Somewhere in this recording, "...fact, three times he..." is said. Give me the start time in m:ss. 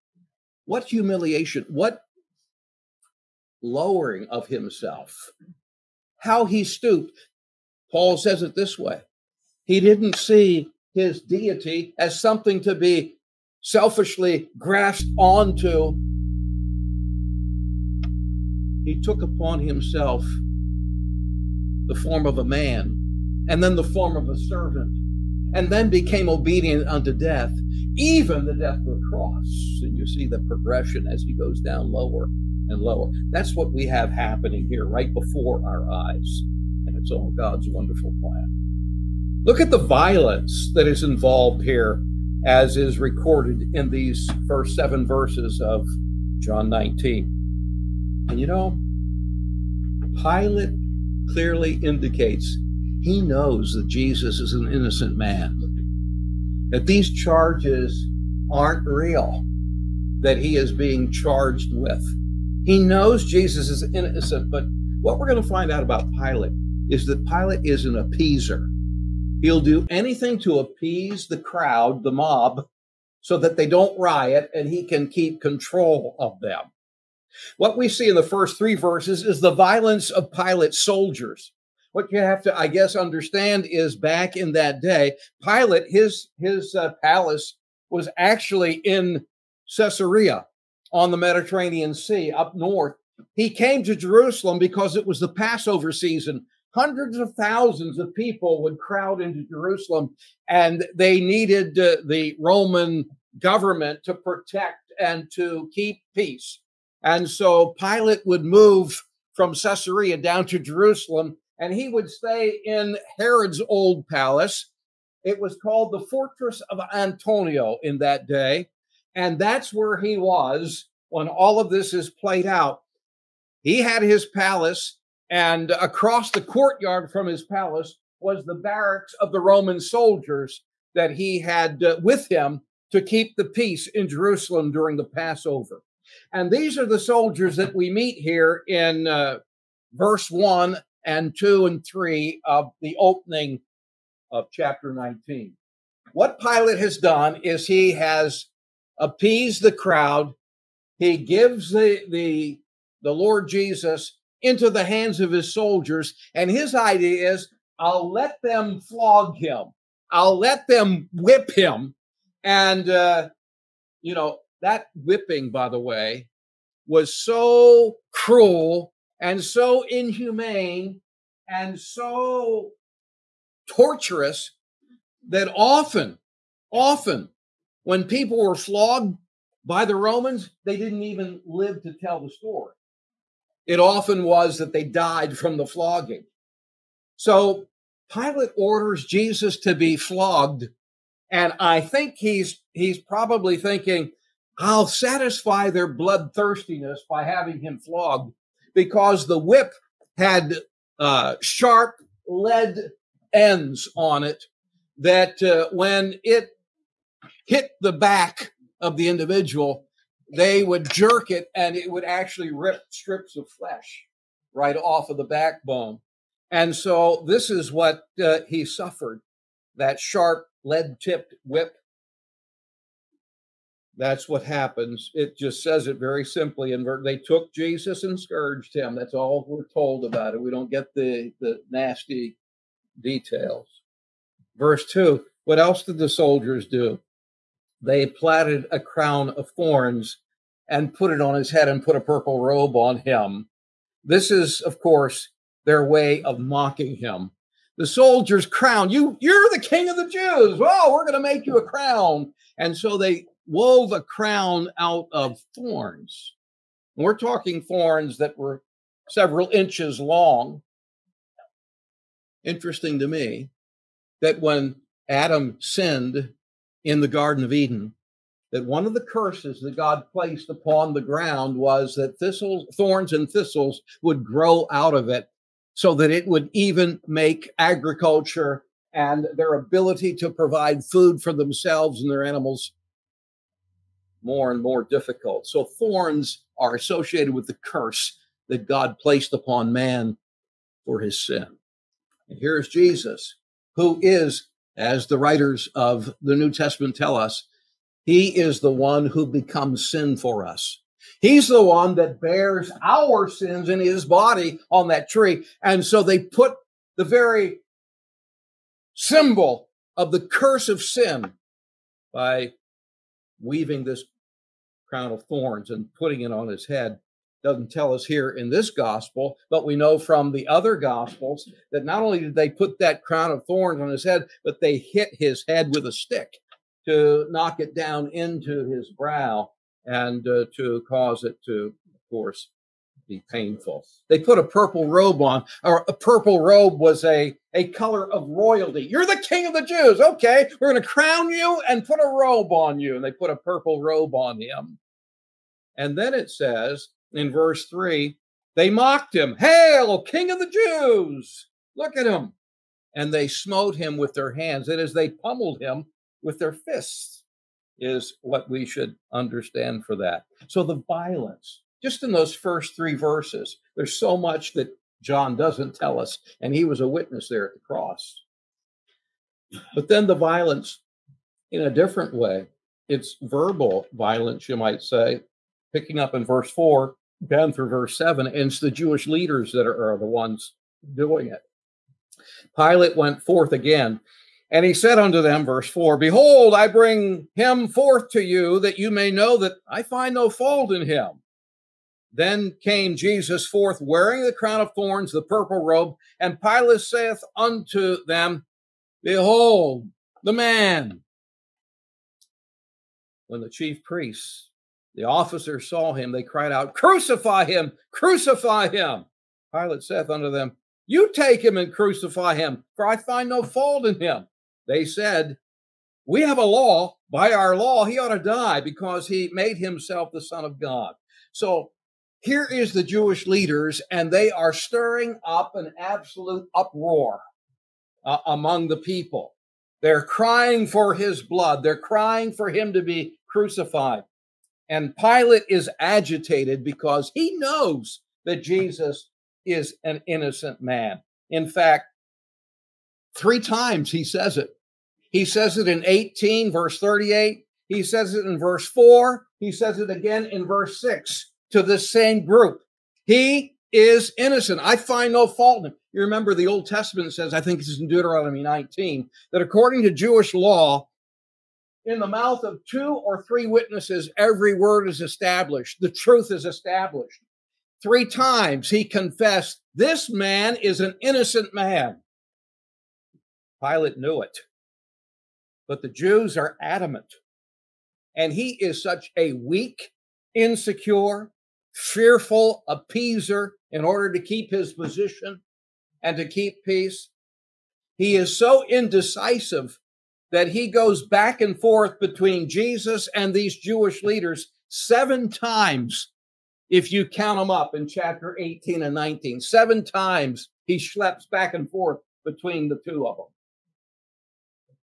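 7:21.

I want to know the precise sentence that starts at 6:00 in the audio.
So the violence, just in those first three verses, there's so much that John doesn't tell us.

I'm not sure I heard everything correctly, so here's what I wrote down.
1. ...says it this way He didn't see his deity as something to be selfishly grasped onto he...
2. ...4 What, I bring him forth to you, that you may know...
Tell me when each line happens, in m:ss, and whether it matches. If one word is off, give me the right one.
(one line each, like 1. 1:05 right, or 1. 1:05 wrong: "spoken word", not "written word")
1. 0:08 right
2. 6:25 wrong: "Behold", not "What".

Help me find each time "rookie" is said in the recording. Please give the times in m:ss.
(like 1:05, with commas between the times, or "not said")
not said.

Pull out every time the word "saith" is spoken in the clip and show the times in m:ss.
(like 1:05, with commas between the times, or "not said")
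6:36, 6:49.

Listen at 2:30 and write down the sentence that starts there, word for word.
He gives the, the, the Lord Jesus into the hands of his soldiers.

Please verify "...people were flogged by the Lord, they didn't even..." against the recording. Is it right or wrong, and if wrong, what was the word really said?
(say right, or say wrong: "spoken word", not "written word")
wrong: "Romans", not "Lord".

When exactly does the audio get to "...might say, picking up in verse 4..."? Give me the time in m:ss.
6:14.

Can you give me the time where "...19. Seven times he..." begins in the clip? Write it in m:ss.
8:18.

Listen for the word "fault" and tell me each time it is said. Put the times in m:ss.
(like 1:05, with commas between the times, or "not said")
6:30, 6:53, 7:35.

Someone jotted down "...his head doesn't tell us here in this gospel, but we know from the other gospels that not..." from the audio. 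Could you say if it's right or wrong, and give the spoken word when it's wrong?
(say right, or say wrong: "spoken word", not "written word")
right.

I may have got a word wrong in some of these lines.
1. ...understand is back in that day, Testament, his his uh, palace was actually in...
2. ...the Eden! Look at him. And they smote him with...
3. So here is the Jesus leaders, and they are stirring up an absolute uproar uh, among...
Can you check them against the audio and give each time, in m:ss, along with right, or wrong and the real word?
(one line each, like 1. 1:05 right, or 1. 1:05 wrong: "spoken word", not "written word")
1. 1:22 wrong: "Pilate", not "Testament"
2. 5:50 wrong: "Jews", not "Eden"
3. 7:01 wrong: "Jewish", not "Jesus".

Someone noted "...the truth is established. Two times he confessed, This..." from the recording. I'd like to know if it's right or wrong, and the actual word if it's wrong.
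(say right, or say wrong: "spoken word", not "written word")
wrong: "Three", not "Two".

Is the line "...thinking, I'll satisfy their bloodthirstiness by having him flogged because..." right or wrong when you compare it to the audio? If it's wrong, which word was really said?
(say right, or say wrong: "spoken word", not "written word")
right.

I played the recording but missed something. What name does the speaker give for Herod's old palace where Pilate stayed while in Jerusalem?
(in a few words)
Fortress of Antonia.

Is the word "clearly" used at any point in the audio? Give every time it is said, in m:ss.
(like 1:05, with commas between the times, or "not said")
0:51.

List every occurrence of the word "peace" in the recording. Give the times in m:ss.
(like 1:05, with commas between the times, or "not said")
1:46, 2:13, 8:06.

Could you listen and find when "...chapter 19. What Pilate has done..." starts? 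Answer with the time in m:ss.
2:24.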